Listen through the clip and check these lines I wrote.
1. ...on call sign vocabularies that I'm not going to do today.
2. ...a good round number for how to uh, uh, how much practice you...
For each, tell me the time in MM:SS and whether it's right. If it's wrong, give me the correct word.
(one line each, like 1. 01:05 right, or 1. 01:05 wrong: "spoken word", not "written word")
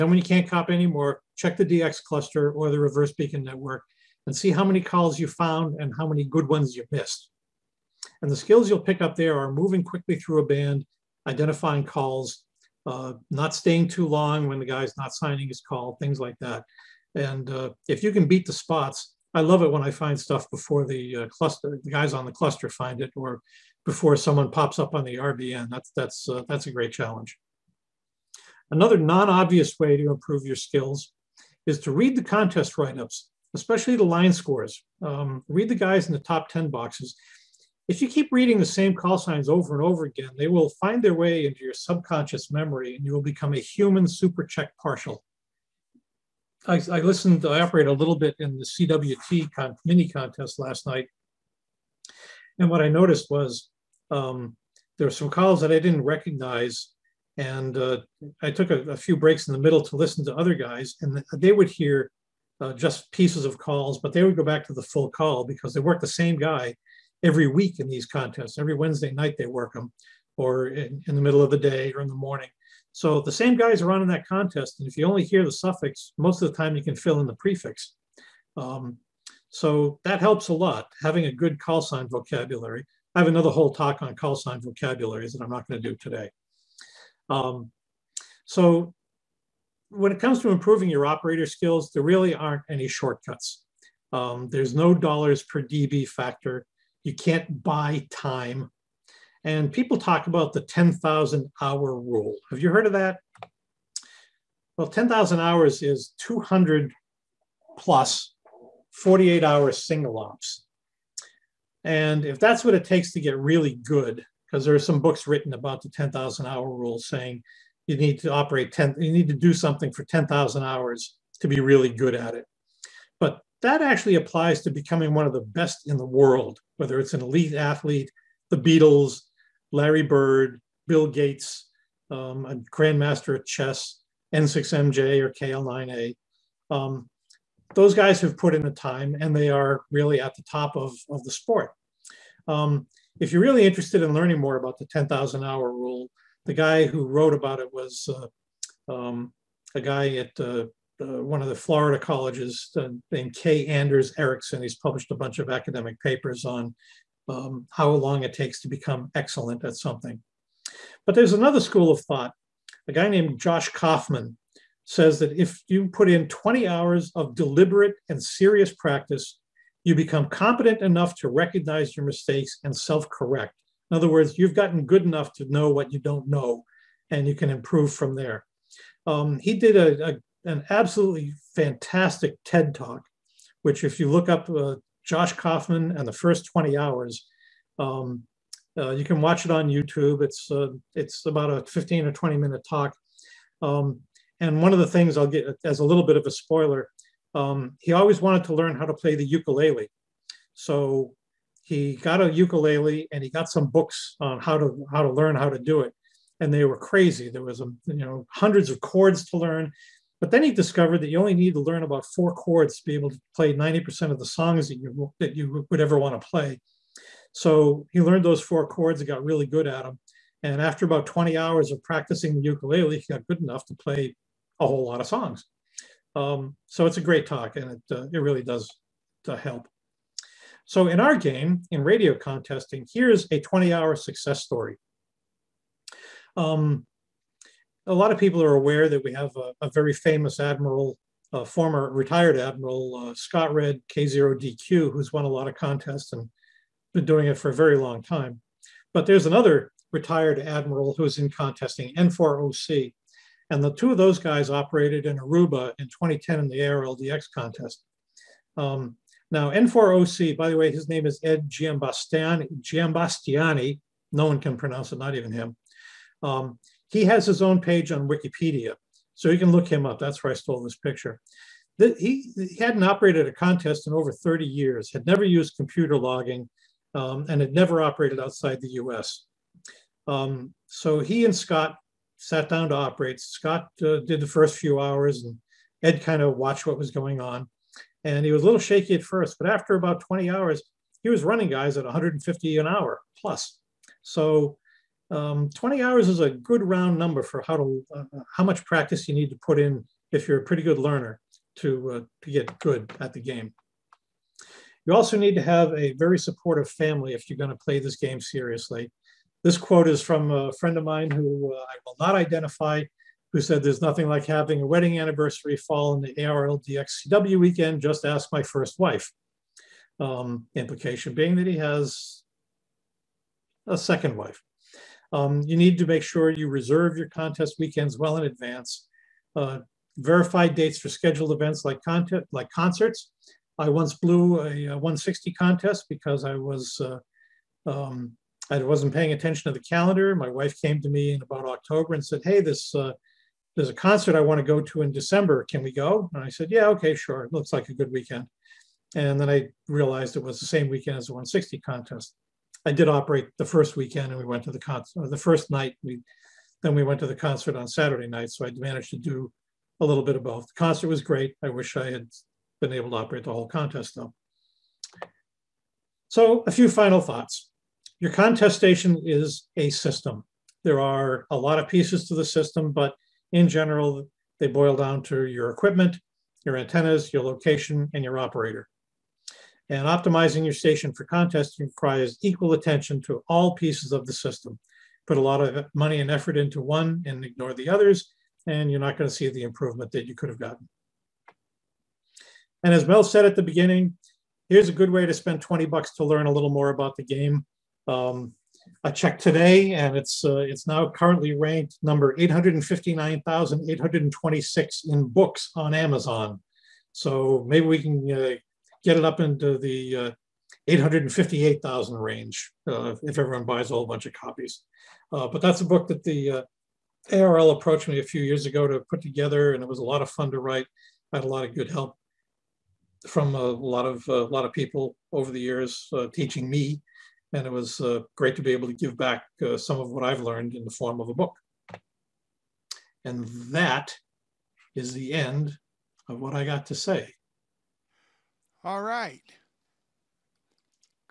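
1. 01:24 right
2. 04:56 right.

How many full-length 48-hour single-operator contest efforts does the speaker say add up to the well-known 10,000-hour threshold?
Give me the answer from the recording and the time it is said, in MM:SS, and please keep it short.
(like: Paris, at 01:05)
200, at 01:46.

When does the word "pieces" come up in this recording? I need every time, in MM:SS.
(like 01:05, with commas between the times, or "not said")
01:03, 06:11, 06:23.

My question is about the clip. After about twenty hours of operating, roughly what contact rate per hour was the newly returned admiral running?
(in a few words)
150 an hour.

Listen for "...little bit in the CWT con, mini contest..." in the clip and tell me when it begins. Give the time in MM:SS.
00:47.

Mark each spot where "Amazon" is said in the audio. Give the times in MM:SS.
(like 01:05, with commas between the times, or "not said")
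06:45.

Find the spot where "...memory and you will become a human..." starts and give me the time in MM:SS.
00:42.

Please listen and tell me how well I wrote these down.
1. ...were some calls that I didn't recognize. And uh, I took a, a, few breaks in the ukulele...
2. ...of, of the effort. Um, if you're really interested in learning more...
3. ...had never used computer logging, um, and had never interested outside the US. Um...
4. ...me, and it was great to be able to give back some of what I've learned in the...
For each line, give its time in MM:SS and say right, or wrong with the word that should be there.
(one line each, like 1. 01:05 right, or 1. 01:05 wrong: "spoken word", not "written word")
1. 00:55 wrong: "middle", not "ukulele"
2. 02:20 wrong: "sport", not "effort"
3. 04:34 wrong: "operated", not "interested"
4. 07:06 right.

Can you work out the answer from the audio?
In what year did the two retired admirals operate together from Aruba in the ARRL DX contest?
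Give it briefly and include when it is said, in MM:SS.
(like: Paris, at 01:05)
2010, at 04:15.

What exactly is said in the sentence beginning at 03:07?
Um, uh, you can watch it on YouTube.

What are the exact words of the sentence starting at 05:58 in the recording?
So I managed to do a little bit of both.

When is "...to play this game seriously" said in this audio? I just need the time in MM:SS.
05:07.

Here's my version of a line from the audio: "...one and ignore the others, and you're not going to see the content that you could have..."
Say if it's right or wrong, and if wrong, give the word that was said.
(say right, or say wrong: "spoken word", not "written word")
wrong: "improvement", not "content".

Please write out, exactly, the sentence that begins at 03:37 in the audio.
So he learned those four chords and got really good at them.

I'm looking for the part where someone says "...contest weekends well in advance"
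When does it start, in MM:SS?
05:27.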